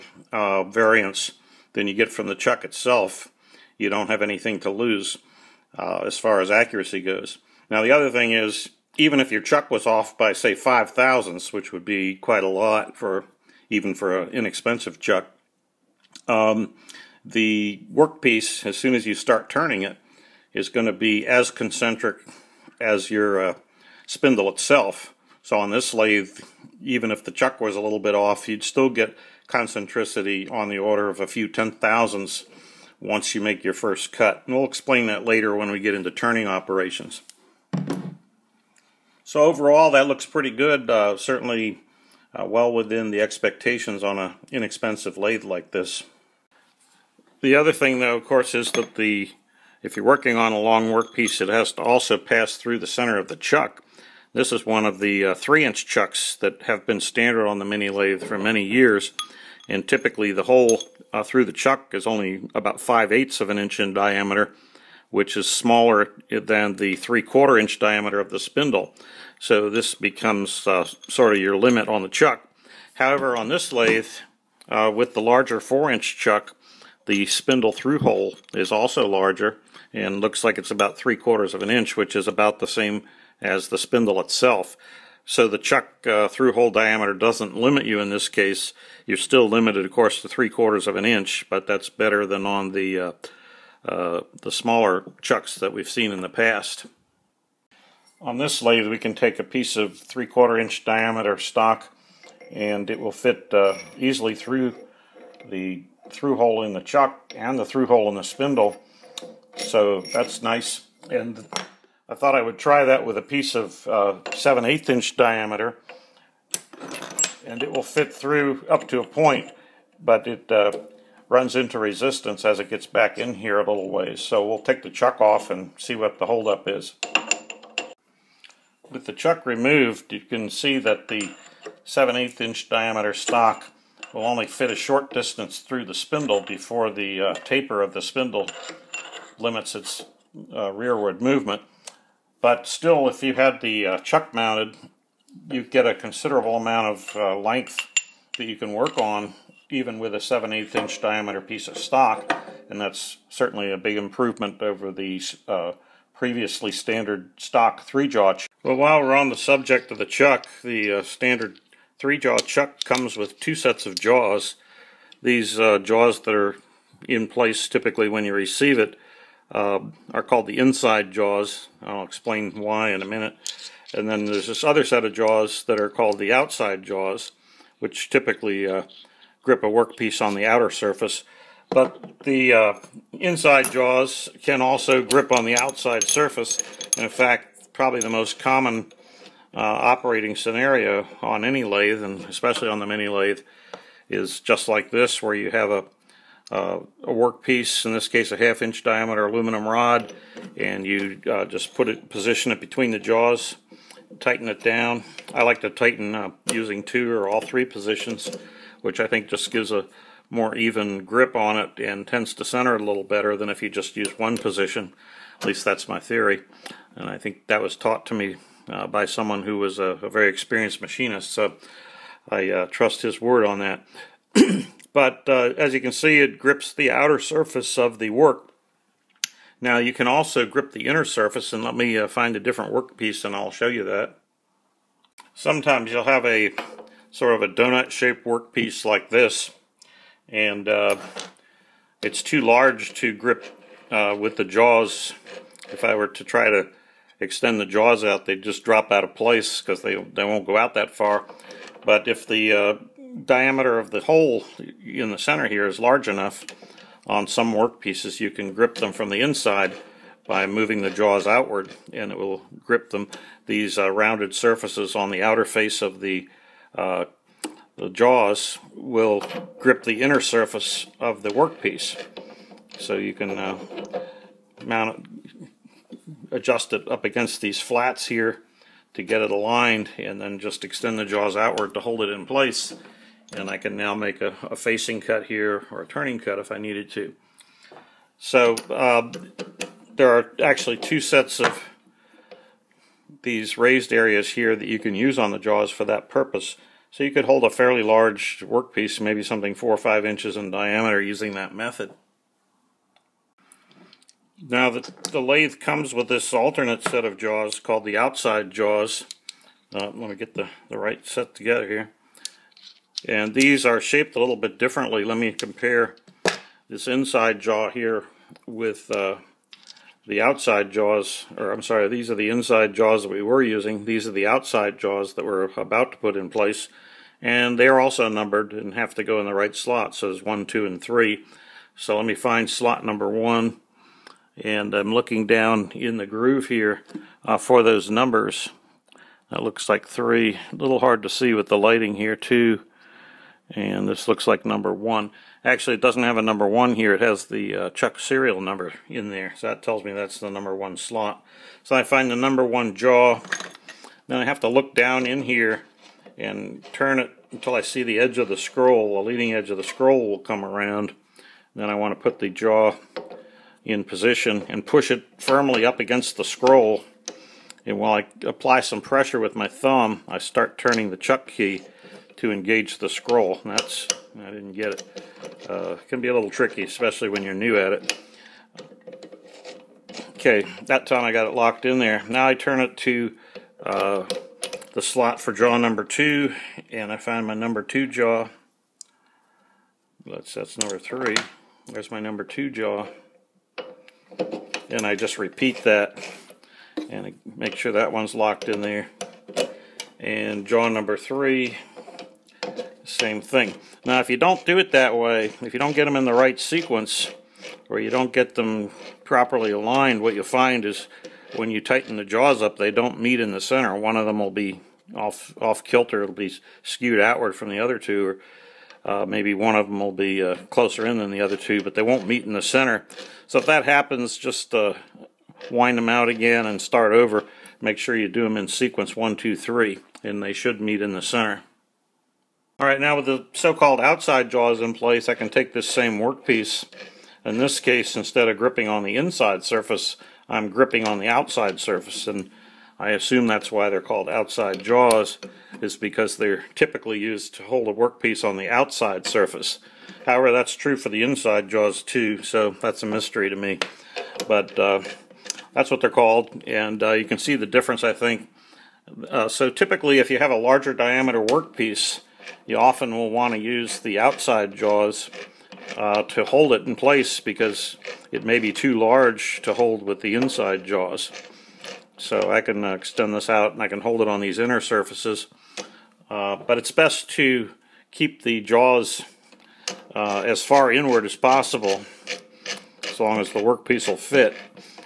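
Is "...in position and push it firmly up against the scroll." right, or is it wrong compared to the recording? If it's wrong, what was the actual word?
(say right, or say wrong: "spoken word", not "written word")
right.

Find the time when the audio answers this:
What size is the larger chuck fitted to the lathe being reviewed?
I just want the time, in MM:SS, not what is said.
01:15.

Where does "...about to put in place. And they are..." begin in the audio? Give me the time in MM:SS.
05:25.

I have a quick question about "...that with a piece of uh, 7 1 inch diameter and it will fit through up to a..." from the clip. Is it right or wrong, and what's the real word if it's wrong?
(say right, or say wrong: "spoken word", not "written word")
wrong: "8", not "1".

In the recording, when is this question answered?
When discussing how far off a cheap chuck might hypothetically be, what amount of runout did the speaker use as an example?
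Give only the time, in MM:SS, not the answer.
00:10.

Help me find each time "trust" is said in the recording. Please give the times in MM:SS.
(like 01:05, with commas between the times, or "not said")
03:42.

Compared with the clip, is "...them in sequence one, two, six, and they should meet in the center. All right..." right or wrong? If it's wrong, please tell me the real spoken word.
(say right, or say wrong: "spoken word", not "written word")
wrong: "three", not "six".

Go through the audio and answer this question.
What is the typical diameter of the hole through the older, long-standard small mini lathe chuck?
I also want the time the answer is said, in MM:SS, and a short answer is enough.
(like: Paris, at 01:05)
5/8 inch, at 01:02.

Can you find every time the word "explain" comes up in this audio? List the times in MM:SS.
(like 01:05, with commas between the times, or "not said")
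00:34, 02:52.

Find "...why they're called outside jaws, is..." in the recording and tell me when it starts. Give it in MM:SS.
07:23.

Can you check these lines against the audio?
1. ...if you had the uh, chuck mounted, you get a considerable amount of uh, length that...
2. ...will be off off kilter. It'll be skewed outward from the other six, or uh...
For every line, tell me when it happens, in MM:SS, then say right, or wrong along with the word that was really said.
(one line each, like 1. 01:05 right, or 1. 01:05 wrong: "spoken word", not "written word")
1. 02:23 right
2. 06:54 wrong: "two", not "six".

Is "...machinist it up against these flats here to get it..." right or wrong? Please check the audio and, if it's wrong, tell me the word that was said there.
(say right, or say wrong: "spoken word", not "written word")
wrong: "adjust", not "machinist".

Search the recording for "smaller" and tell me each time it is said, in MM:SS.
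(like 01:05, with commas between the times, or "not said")
01:05, 01:34.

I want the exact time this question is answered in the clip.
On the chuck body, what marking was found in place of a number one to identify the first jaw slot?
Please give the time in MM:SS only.
05:47.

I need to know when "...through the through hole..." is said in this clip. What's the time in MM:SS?
01:44.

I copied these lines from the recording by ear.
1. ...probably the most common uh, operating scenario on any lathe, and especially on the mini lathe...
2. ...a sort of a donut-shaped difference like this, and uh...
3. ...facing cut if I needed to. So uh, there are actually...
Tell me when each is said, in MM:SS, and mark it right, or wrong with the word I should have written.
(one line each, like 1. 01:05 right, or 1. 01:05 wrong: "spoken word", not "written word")
1. 03:07 right
2. 03:56 wrong: "workpiece", not "difference"
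3. 04:45 wrong: "turning", not "facing".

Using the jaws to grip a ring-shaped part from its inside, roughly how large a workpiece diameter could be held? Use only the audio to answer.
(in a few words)
4 or 5 inches.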